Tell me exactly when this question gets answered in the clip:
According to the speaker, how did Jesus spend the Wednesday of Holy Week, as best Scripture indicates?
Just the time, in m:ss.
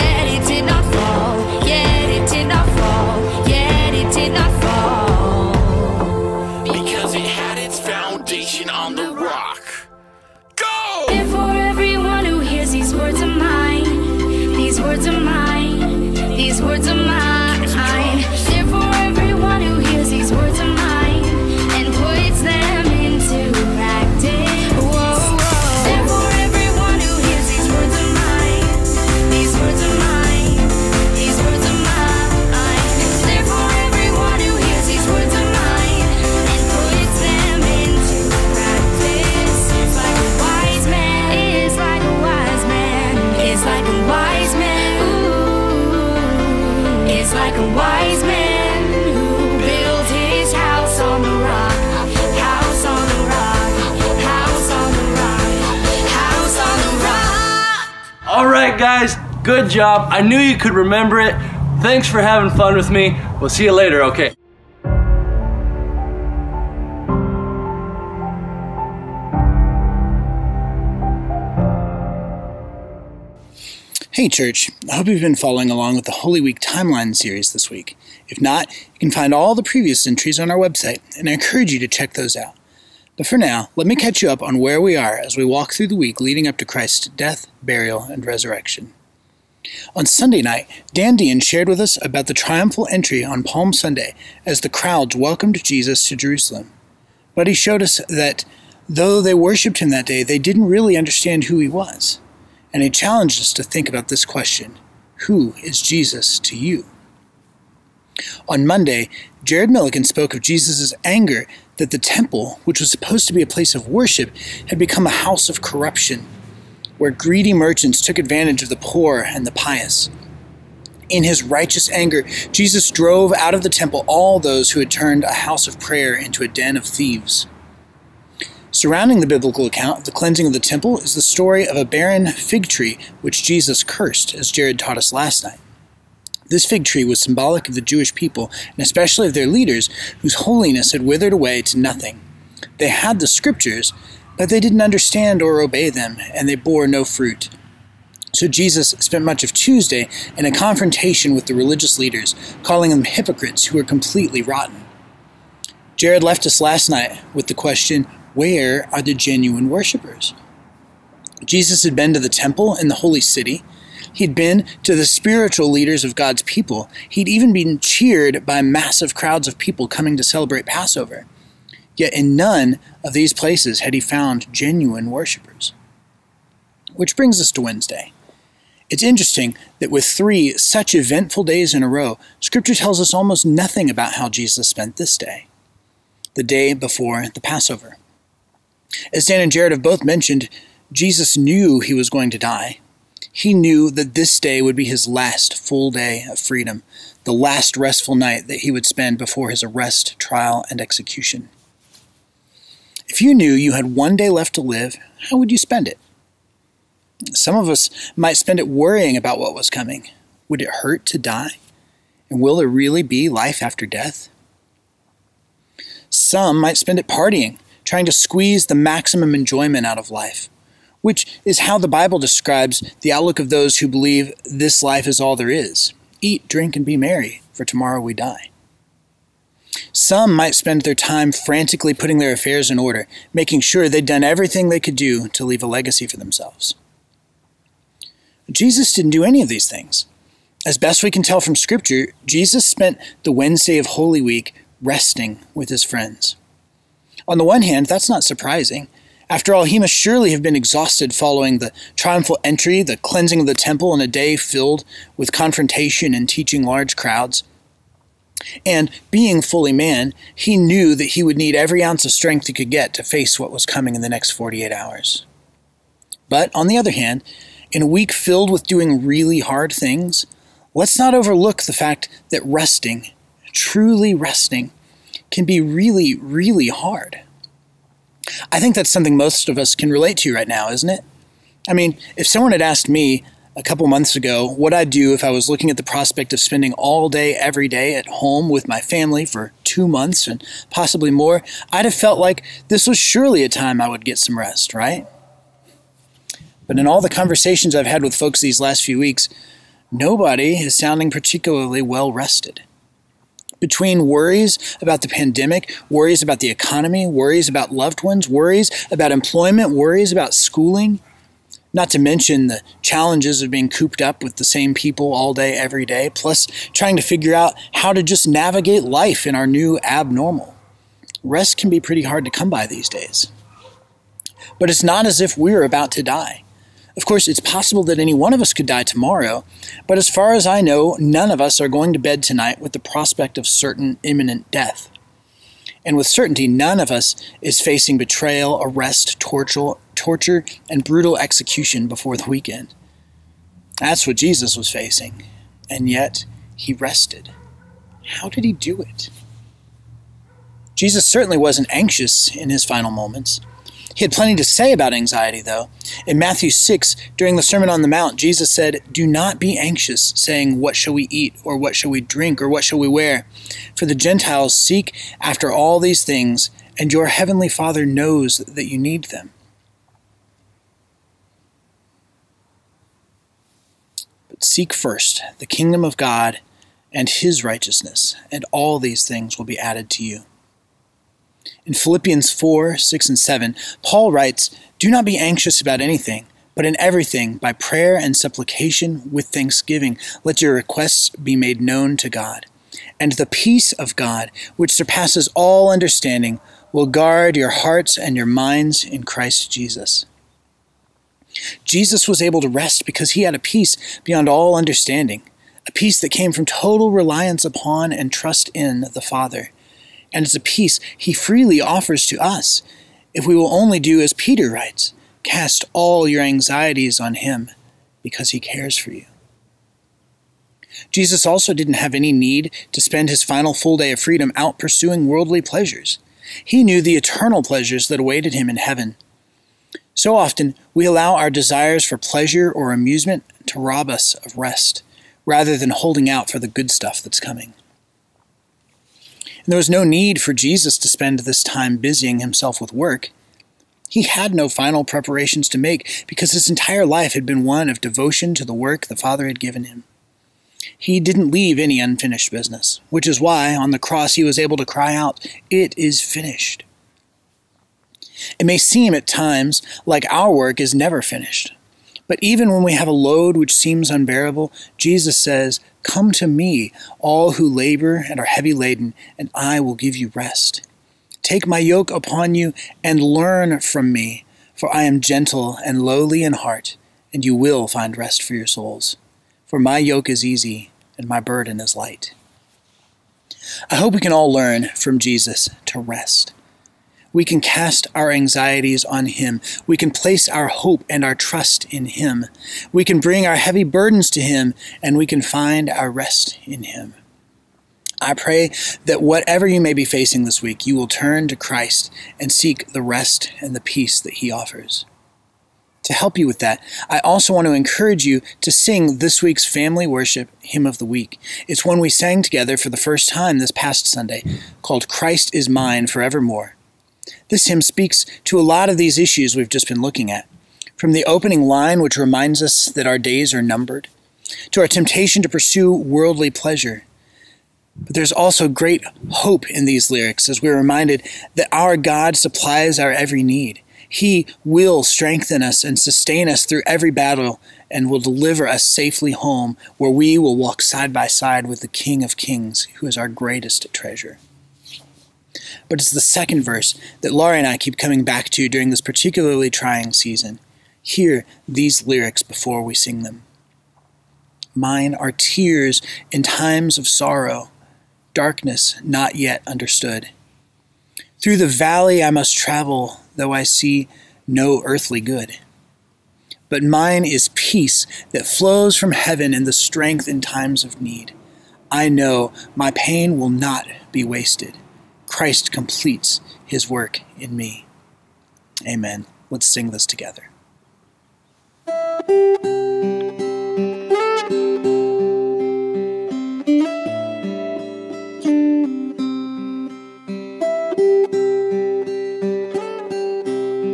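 4:04.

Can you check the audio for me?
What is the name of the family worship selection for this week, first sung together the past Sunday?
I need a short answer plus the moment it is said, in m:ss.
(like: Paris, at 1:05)
Christ is Mine Forevermore, at 8:34.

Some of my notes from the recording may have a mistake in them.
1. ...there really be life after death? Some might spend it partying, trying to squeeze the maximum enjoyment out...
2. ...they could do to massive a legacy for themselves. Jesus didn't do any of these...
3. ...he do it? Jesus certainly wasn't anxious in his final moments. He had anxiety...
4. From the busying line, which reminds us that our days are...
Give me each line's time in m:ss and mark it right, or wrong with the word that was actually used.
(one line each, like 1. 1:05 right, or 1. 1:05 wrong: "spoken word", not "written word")
1. 3:32 right
2. 3:54 wrong: "leave", not "massive"
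3. 5:48 wrong: "plenty", not "anxiety"
4. 8:40 wrong: "opening", not "busying".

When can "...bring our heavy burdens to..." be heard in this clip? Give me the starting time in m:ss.
8:13.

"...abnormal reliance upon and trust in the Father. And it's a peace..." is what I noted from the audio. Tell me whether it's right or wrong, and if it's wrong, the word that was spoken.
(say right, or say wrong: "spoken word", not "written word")
wrong: "total", not "abnormal".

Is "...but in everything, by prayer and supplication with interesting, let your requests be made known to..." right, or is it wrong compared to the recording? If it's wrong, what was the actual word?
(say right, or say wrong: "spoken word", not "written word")
wrong: "thanksgiving", not "interesting".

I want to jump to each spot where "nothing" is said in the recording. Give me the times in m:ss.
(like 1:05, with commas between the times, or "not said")
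2:21, 3:03.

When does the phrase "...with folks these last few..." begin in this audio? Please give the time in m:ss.
4:58.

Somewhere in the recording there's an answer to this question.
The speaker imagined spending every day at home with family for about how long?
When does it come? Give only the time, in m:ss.
4:49.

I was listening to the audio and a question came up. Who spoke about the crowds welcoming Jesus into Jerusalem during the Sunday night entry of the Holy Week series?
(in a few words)
Dan Dean.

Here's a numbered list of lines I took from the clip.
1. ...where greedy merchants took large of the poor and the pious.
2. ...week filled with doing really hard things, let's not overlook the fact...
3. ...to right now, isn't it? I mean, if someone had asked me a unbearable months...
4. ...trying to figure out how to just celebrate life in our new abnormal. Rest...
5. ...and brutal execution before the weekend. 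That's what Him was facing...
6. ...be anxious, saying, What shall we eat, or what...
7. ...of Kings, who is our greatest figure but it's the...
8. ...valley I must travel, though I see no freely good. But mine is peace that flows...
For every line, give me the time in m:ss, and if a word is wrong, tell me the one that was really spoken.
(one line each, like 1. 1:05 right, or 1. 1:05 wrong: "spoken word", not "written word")
1. 1:57 wrong: "advantage", not "large"
2. 4:27 right
3. 4:40 wrong: "couple", not "unbearable"
4. 5:16 wrong: "navigate", not "celebrate"
5. 5:40 wrong: "Jesus", not "Him"
6. 5:59 right
7. 9:02 wrong: "treasure", not "figure"
8. 9:21 wrong: "earthly", not "freely".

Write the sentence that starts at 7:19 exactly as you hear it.
And there was no need for Jesus to spend this time busying himself with work.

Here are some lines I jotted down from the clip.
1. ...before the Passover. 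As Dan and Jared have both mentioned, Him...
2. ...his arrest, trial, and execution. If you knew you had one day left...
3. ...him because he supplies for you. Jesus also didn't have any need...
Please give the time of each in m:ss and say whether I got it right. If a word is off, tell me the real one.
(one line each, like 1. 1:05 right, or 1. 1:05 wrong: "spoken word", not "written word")
1. 3:06 wrong: "Jesus", not "Him"
2. 3:19 right
3. 6:57 wrong: "cares", not "supplies".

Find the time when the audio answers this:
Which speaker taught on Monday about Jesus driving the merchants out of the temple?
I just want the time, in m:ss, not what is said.
1:49.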